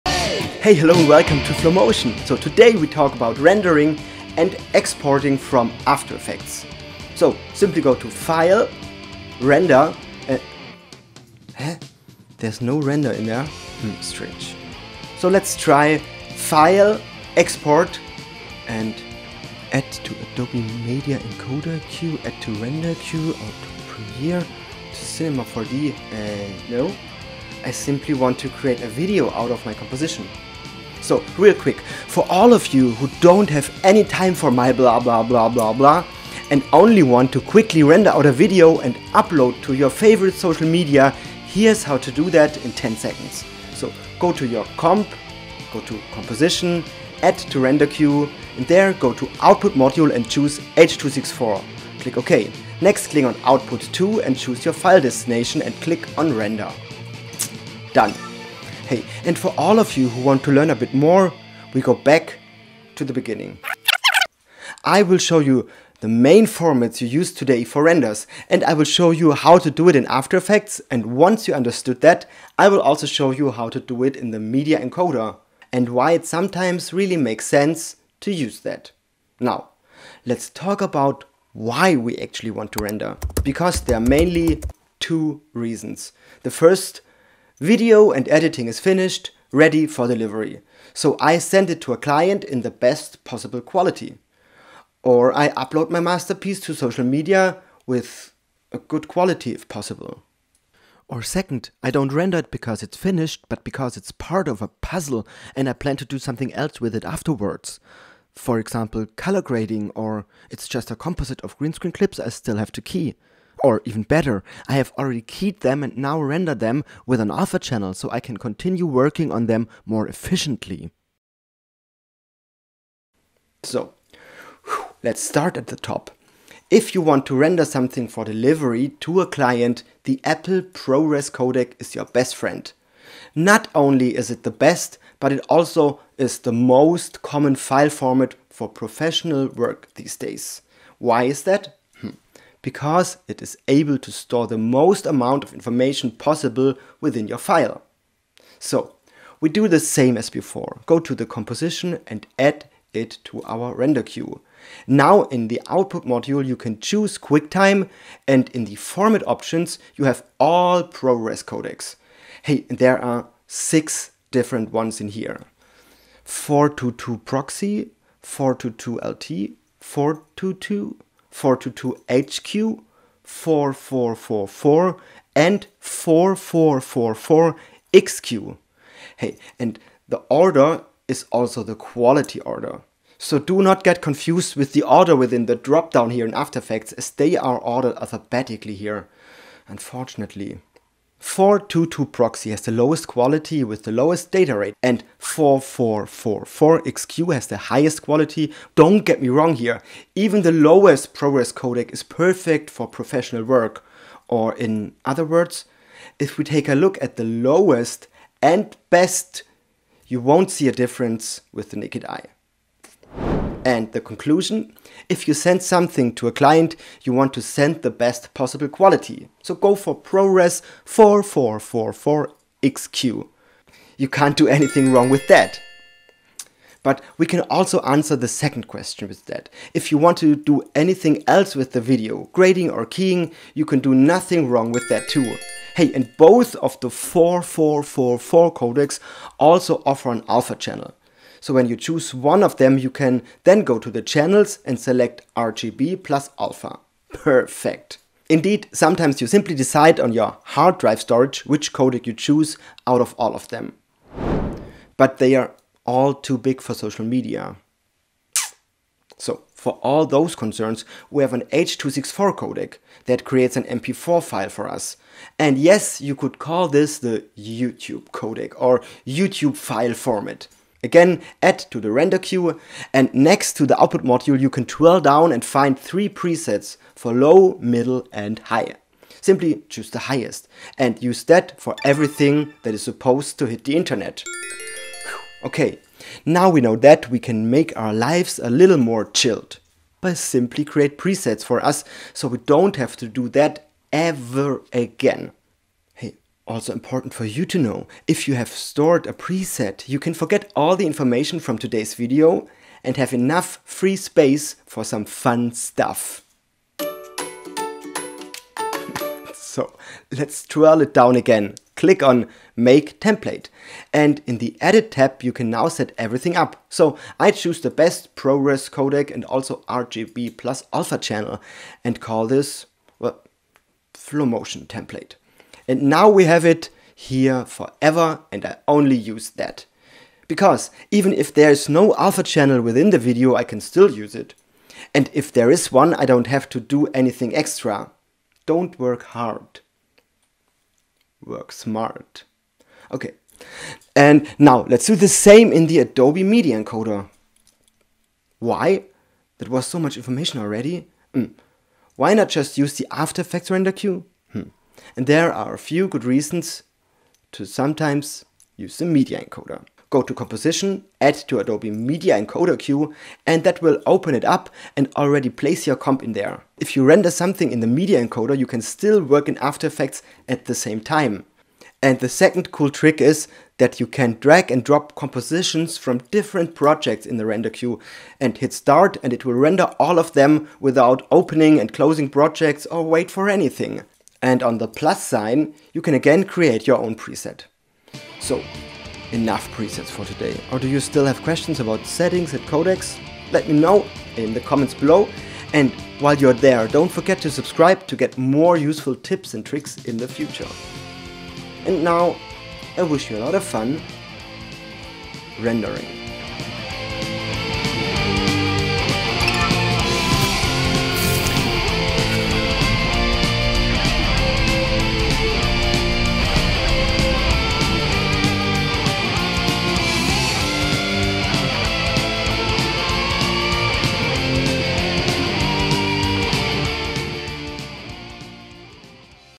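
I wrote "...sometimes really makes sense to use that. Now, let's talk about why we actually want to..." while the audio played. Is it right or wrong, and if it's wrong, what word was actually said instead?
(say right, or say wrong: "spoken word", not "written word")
right.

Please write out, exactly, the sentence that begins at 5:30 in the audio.
Because even if there is no alpha channel within the video, I can still use it.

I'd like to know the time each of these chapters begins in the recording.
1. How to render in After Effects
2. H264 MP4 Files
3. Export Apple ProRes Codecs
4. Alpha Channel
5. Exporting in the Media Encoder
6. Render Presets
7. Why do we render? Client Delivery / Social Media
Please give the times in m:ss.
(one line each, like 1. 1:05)
1. 0:40
2. 4:16
3. 2:04
4. 3:55
5. 5:45
6. 4:50
7. 1:20.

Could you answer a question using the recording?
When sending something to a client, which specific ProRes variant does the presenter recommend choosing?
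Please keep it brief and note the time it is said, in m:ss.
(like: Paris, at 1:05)
ProRes 4444XQ, at 3:39.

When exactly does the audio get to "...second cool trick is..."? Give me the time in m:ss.
6:12.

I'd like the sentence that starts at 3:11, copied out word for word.
422 proxy has the lowest quality with the lowest data rate and 4444 XQ has the highest quality.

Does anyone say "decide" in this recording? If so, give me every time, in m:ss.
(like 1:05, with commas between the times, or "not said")
4:09.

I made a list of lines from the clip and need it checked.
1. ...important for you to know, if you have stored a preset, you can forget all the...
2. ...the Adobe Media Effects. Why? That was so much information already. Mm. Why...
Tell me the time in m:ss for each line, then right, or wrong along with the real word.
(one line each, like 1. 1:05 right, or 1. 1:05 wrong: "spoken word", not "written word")
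1. 4:56 right
2. 5:45 wrong: "Encoder", not "Effects".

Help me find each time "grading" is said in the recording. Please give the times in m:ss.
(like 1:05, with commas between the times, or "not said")
1:49, 3:52.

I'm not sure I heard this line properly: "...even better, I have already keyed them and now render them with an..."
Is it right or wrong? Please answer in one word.
right.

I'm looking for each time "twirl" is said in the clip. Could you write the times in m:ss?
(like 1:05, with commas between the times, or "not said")
4:34, 5:10.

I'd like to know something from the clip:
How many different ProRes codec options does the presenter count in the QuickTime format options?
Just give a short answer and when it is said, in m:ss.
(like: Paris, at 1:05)
6, at 2:43.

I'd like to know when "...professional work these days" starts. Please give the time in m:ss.
2:18.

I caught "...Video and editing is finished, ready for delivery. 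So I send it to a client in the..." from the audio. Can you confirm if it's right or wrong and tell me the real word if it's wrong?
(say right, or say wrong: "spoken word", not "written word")
right.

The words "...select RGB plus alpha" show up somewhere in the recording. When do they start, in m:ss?
4:04.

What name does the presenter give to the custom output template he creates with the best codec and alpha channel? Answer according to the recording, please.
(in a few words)
Flomotion Template.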